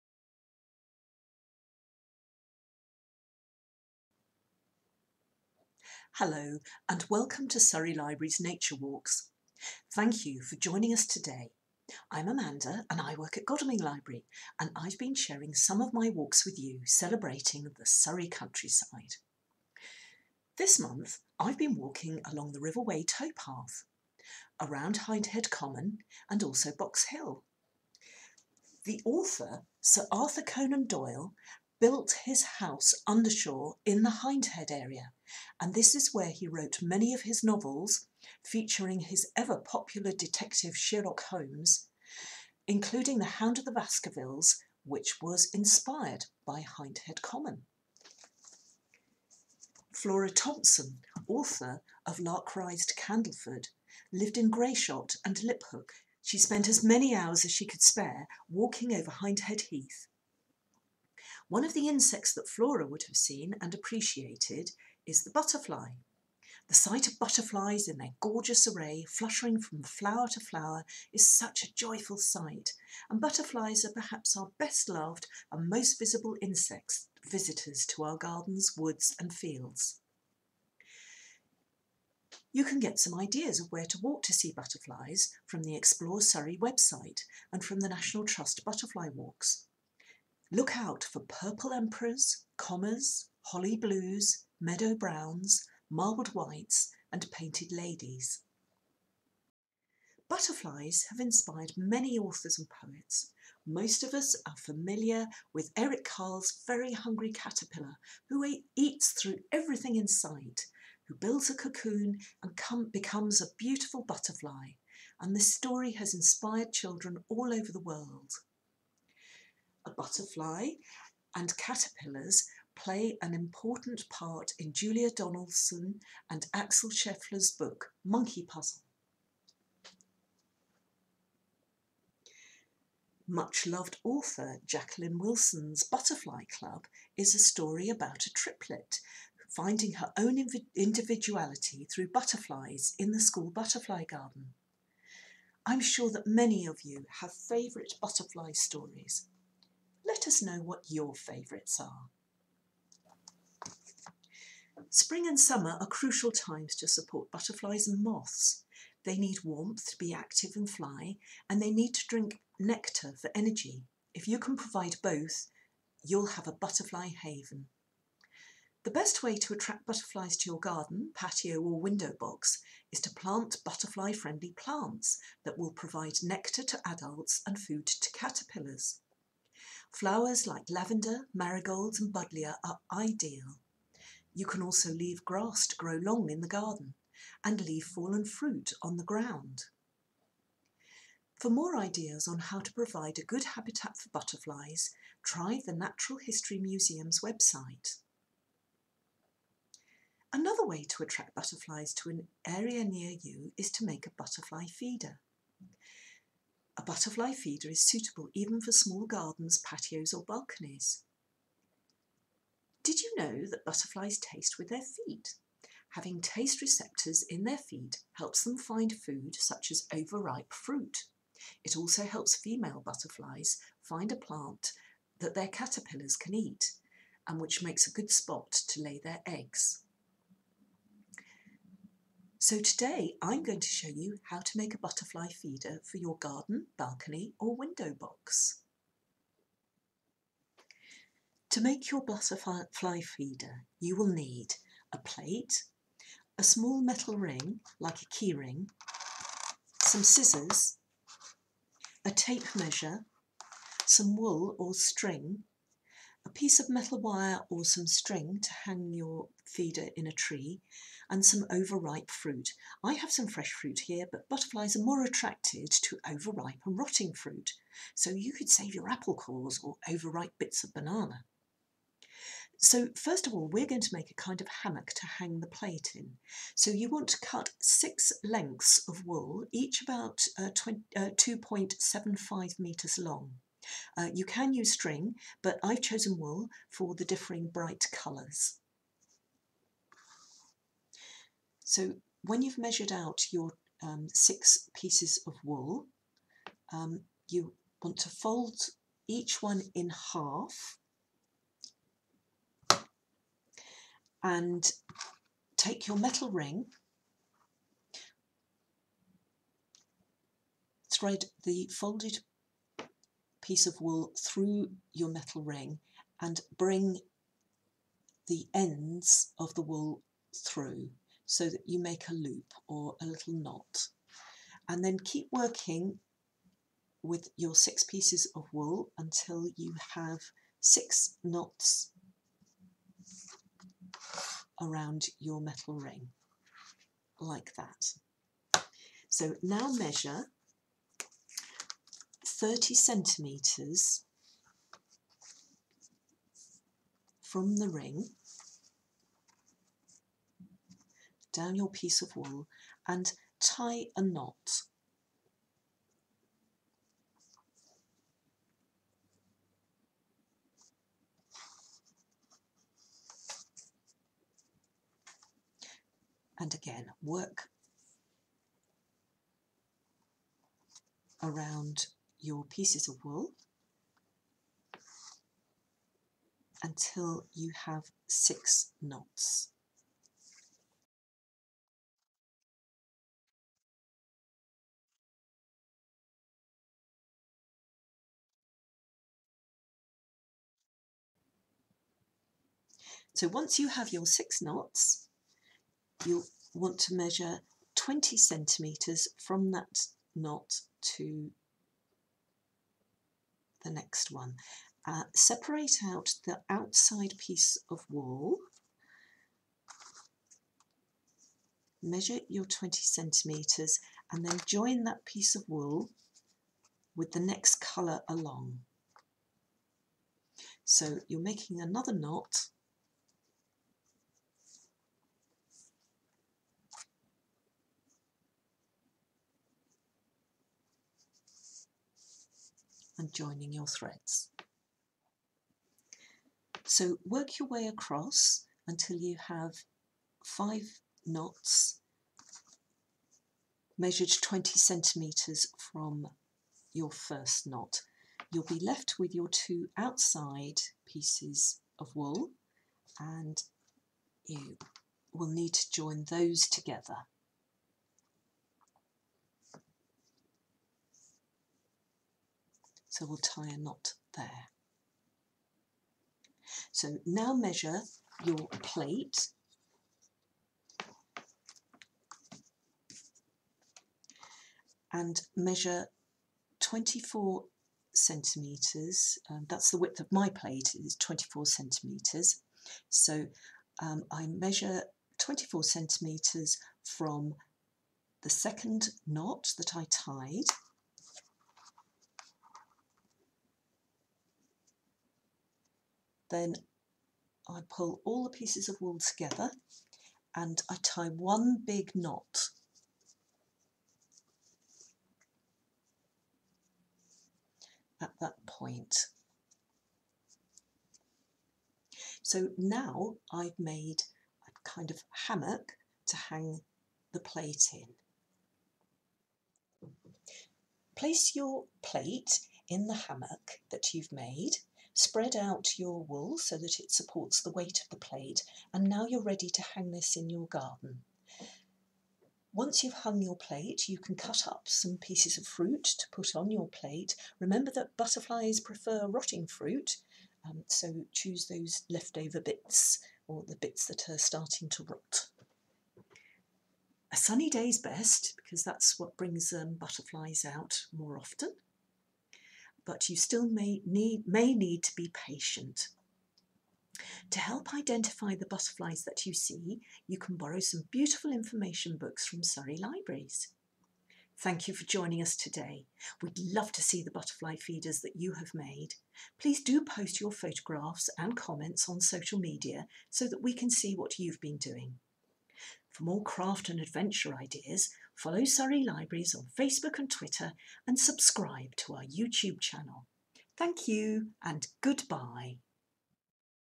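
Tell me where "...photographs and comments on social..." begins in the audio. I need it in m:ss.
9:30.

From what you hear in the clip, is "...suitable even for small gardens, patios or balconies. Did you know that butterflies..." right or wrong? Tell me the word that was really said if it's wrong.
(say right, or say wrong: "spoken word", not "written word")
right.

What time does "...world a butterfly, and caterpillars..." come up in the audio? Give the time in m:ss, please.
1:57.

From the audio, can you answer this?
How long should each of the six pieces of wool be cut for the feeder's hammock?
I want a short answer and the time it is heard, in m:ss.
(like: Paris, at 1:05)
2.75 metres, at 4:41.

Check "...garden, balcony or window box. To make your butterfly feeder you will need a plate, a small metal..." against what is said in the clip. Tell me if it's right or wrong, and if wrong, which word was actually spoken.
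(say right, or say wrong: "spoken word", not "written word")
right.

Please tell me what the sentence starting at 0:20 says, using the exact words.
This month, I've been walking along the River Wey towpath, around Hindhead Common and also Box Hill.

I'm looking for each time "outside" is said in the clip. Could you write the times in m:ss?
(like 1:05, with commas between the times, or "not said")
6:46, 7:29.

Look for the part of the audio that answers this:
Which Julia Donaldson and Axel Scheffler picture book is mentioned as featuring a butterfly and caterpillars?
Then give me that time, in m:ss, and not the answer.
2:08.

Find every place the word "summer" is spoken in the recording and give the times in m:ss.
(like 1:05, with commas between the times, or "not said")
2:35.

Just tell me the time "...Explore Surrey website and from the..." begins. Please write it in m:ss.
1:25.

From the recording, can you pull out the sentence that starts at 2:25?
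I'm sure that many of you have favourite butterfly stories let us know what your favourites are.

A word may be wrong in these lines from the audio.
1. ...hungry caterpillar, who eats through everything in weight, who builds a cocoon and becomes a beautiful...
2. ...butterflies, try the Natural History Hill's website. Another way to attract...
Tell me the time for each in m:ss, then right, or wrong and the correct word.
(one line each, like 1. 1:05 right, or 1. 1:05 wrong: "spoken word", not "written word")
1. 1:46 wrong: "sight", not "weight"
2. 3:14 wrong: "Museum", not "Hill".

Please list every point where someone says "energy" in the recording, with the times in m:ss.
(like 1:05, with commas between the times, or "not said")
2:43.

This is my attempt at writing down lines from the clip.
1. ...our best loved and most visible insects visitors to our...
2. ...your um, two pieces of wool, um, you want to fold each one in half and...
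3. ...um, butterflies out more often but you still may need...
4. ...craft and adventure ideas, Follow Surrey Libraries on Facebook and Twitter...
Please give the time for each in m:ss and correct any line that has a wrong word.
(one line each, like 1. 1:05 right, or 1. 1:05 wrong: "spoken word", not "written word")
1. 1:14 right
2. 4:53 wrong: "six", not "two"
3. 9:09 right
4. 9:36 right.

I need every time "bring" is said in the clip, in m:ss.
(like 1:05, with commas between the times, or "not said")
5:16, 9:09.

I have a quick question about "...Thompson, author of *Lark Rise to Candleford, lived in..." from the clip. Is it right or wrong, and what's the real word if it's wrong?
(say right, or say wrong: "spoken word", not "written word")
right.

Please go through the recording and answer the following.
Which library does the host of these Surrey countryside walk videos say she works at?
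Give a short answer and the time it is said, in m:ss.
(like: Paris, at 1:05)
Godalming Library, at 0:13.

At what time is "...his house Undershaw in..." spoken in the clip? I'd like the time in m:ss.
0:32.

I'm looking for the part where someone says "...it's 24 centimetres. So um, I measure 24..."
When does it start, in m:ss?
8:00.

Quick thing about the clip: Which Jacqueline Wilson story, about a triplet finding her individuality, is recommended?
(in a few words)
Butterfly Club.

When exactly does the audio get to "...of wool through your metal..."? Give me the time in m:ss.
5:13.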